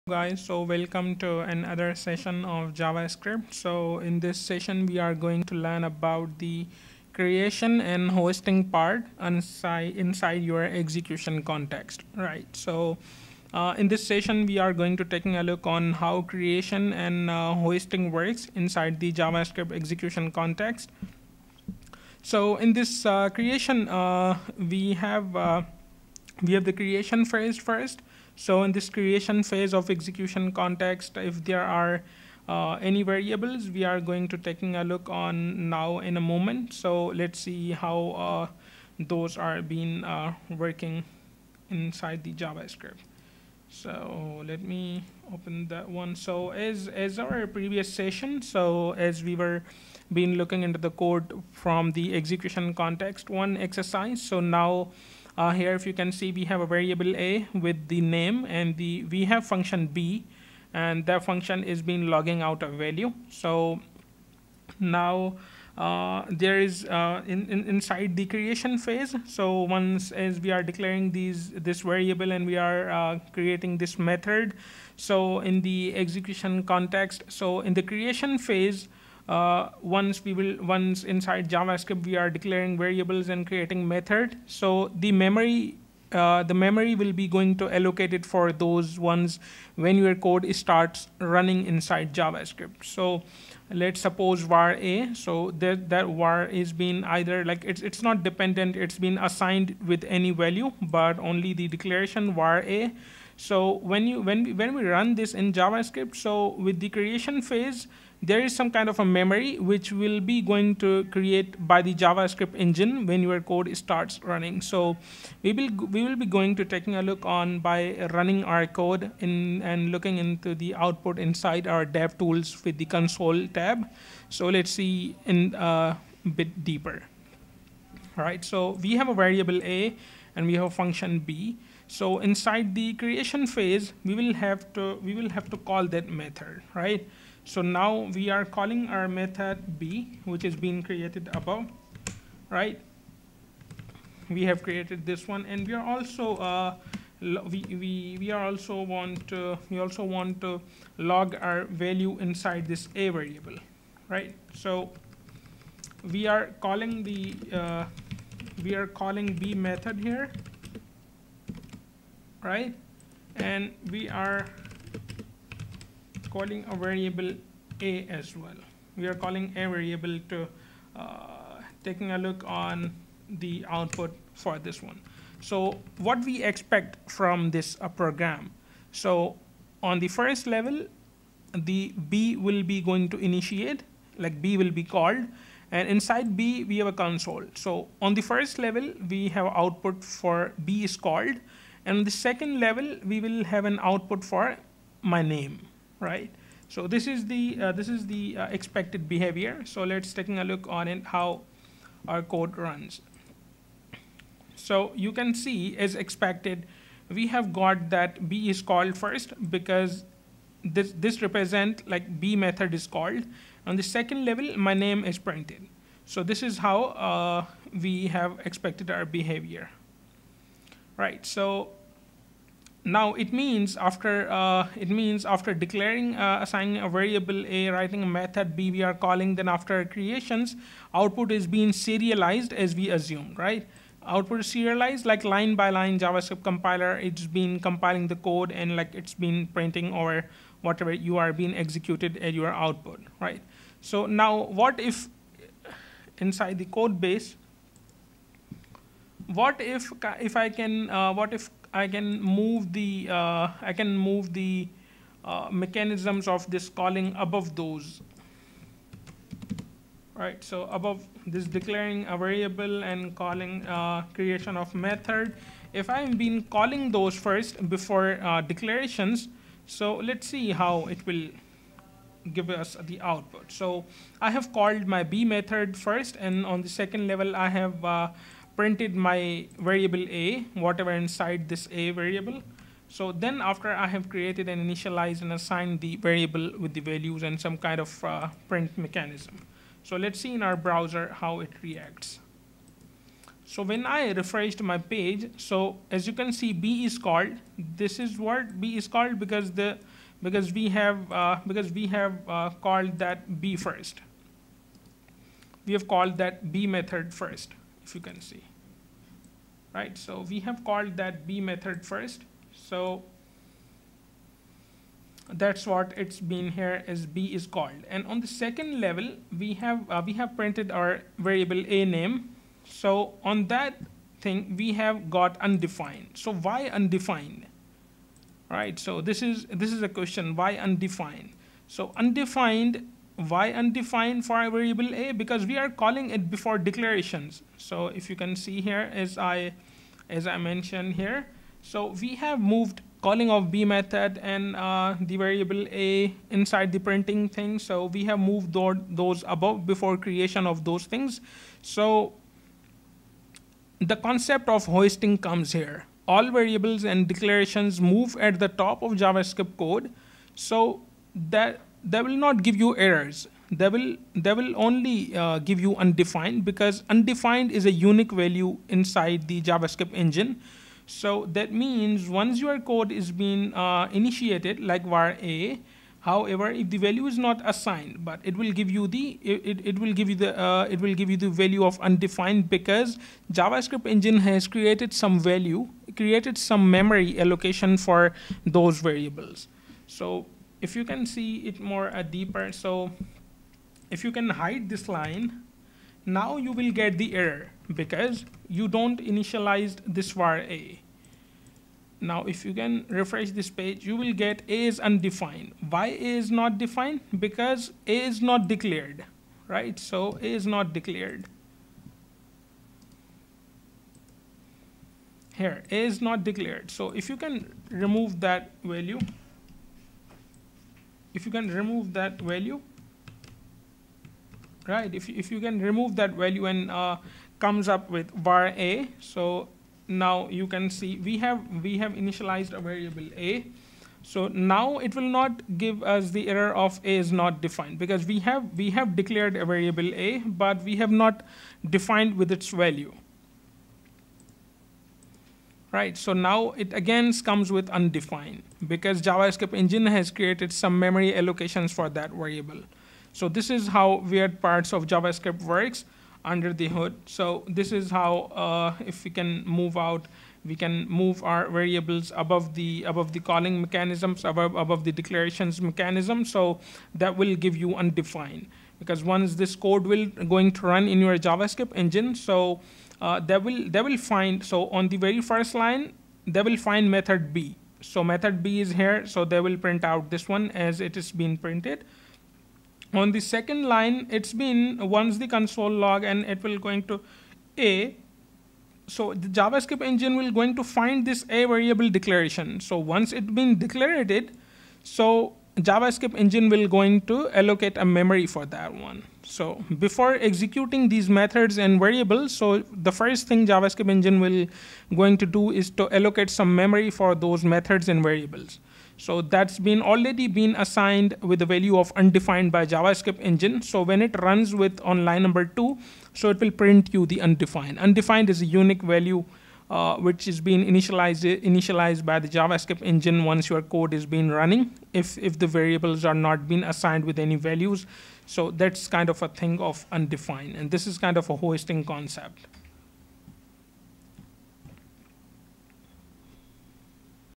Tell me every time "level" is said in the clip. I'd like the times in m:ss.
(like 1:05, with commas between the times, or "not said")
3:00, 3:08, 3:12, 3:34, 4:37, 5:18.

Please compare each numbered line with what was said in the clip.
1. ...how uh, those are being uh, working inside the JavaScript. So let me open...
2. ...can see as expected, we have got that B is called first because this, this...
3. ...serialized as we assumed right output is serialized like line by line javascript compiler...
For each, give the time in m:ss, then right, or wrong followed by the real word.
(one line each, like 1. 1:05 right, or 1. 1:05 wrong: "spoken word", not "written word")
1. 0:37 right
2. 3:25 right
3. 3:51 right.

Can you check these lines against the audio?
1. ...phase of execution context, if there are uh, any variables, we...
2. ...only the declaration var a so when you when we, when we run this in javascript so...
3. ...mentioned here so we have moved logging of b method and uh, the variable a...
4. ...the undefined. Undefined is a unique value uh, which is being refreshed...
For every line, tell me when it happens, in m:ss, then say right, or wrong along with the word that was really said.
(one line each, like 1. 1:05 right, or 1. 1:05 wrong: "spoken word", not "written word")
1. 0:29 right
2. 1:41 right
3. 5:40 wrong: "calling", not "logging"
4. 8:37 wrong: "initialized", not "refreshed".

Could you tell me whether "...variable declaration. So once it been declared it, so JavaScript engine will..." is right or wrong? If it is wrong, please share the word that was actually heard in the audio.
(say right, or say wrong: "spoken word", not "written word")
right.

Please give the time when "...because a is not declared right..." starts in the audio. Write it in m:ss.
6:47.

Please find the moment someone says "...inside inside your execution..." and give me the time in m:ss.
0:09.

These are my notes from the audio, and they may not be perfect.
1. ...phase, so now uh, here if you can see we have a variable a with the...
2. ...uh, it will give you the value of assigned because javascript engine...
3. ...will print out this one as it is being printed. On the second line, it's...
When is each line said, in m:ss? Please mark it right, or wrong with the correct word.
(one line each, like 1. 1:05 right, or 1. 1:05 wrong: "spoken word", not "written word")
1. 0:53 wrong: "exercise", not "phase"
2. 6:20 wrong: "undefined", not "assigned"
3. 7:59 right.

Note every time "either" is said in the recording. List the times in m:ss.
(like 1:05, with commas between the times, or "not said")
1:37.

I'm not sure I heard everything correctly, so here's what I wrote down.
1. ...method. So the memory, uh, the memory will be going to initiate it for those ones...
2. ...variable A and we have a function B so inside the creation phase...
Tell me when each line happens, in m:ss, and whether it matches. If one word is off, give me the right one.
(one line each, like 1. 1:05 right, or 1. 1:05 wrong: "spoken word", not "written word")
1. 1:23 wrong: "allocate", not "initiate"
2. 2:09 right.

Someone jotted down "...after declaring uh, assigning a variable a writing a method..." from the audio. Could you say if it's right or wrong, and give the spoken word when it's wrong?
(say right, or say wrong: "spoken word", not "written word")
right.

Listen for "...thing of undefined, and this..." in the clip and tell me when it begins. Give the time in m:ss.
8:49.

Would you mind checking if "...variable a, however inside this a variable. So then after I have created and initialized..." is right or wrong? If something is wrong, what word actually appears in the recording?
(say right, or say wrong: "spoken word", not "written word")
wrong: "whatever", not "however".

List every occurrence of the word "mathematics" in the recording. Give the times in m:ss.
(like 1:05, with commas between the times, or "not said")
not said.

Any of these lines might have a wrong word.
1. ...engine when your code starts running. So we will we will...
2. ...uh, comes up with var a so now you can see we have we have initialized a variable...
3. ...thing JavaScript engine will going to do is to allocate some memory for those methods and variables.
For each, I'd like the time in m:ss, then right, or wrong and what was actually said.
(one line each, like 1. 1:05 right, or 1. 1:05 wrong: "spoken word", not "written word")
1. 1:52 right
2. 7:06 right
3. 8:23 right.